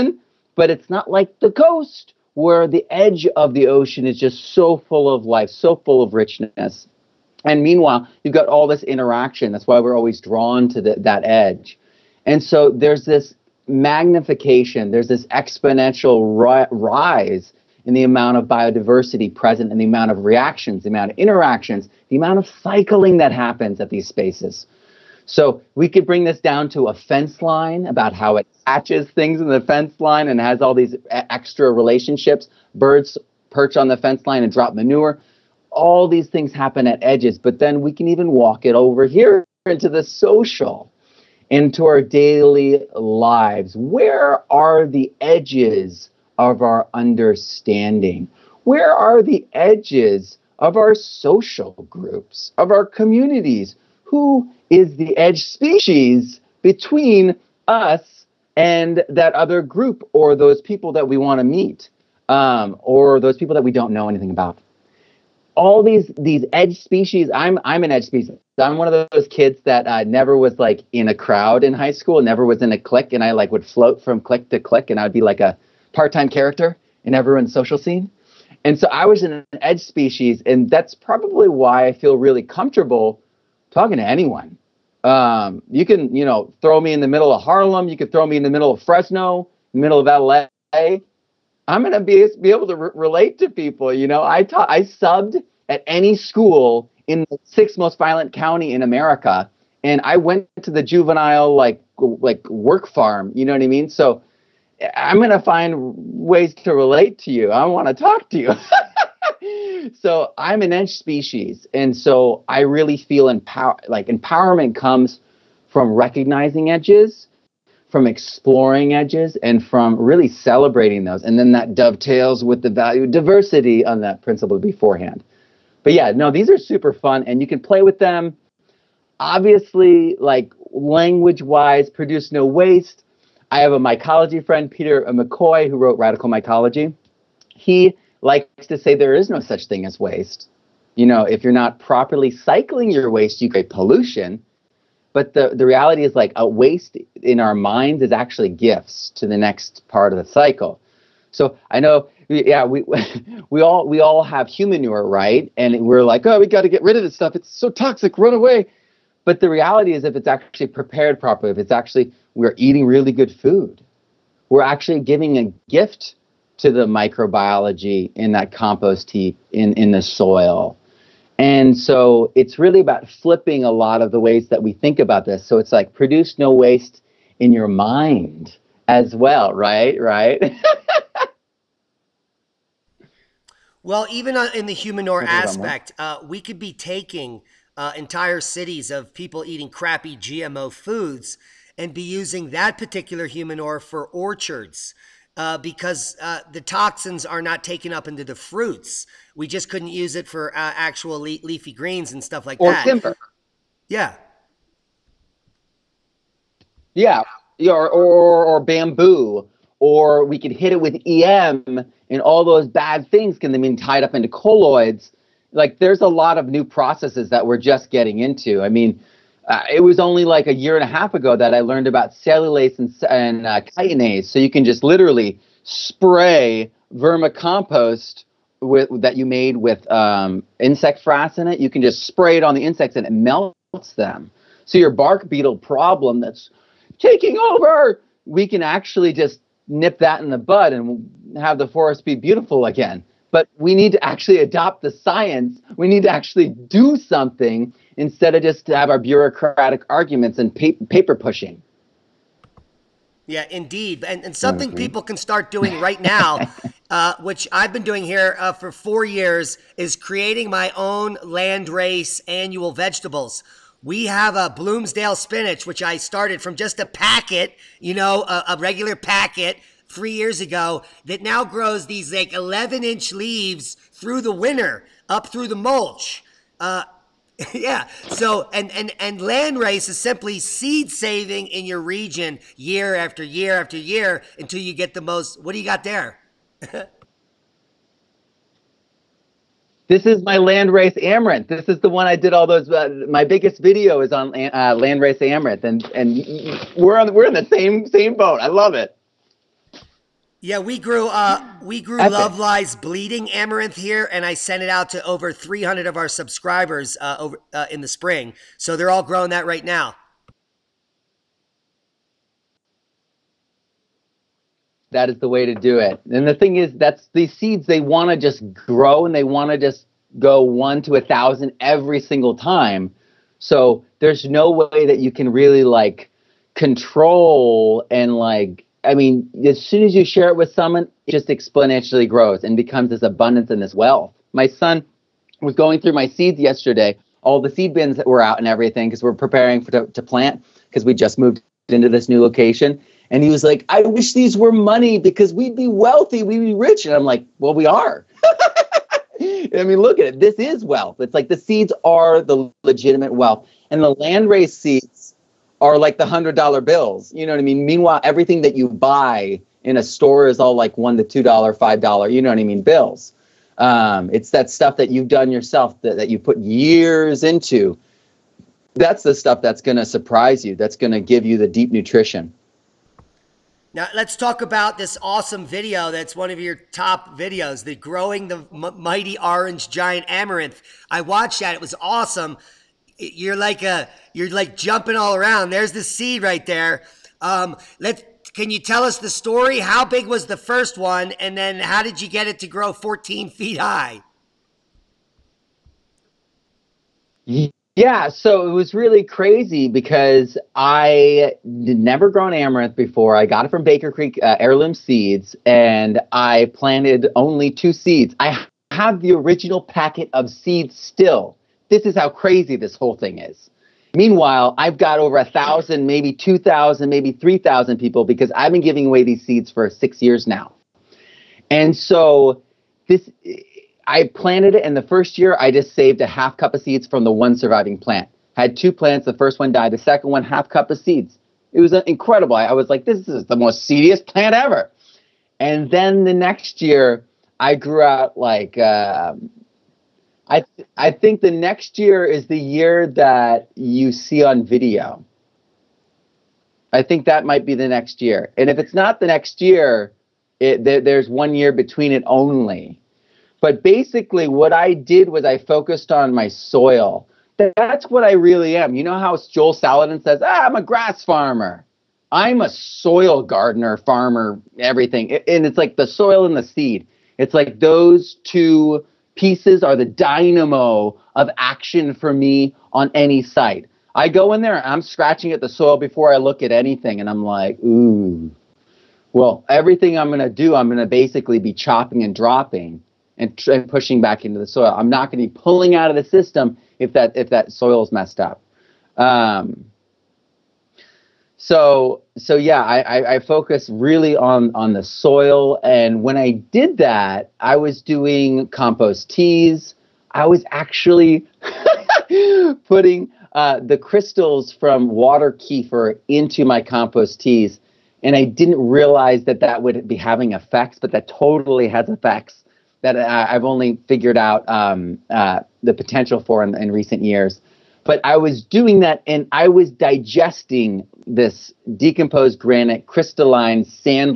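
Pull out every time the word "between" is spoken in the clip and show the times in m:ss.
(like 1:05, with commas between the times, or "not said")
0:56, 7:31.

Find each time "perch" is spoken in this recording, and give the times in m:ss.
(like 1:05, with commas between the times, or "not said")
0:33.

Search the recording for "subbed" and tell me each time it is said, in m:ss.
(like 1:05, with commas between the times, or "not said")
1:34.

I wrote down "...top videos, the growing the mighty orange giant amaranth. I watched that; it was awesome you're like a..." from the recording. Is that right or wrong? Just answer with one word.
right.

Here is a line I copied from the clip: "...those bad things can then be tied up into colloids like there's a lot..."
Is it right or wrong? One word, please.
right.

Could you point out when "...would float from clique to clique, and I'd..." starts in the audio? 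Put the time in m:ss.
1:13.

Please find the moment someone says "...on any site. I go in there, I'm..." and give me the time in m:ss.
7:52.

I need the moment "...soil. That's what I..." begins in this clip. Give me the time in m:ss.
7:36.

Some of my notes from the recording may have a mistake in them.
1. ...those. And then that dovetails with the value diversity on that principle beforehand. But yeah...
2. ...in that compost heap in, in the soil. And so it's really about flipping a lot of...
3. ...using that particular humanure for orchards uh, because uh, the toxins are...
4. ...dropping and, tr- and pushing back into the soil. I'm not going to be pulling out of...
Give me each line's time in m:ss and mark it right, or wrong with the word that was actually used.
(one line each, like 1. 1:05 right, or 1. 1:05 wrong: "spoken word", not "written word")
1. 2:01 right
2. 2:48 right
3. 3:12 right
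4. 8:02 right.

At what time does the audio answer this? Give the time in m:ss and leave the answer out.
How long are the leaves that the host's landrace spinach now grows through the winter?
4:32.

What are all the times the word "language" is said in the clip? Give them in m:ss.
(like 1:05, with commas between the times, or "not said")
2:10.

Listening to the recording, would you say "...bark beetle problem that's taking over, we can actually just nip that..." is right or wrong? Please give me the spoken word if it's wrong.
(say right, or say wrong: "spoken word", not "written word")
right.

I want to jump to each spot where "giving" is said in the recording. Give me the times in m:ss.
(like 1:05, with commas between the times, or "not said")
2:44, 6:58.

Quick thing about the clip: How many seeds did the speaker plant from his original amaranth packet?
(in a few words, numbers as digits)
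2.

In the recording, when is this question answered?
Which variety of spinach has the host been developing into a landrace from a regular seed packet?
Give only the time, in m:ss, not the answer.
4:24.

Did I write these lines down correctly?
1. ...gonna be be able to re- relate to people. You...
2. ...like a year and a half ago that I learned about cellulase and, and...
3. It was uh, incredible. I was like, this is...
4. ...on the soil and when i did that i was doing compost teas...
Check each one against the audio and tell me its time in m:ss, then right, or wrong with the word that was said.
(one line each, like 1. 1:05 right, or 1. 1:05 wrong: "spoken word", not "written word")
1. 1:31 right
2. 3:40 right
3. 7:11 right
4. 8:14 right.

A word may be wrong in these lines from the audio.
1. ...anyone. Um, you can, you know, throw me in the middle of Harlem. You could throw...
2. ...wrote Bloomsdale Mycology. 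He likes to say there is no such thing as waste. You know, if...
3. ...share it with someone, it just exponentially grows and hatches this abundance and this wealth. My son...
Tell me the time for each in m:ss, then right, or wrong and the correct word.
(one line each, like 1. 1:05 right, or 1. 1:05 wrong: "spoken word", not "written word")
1. 1:24 right
2. 2:15 wrong: "Radical", not "Bloomsdale"
3. 5:30 wrong: "becomes", not "hatches".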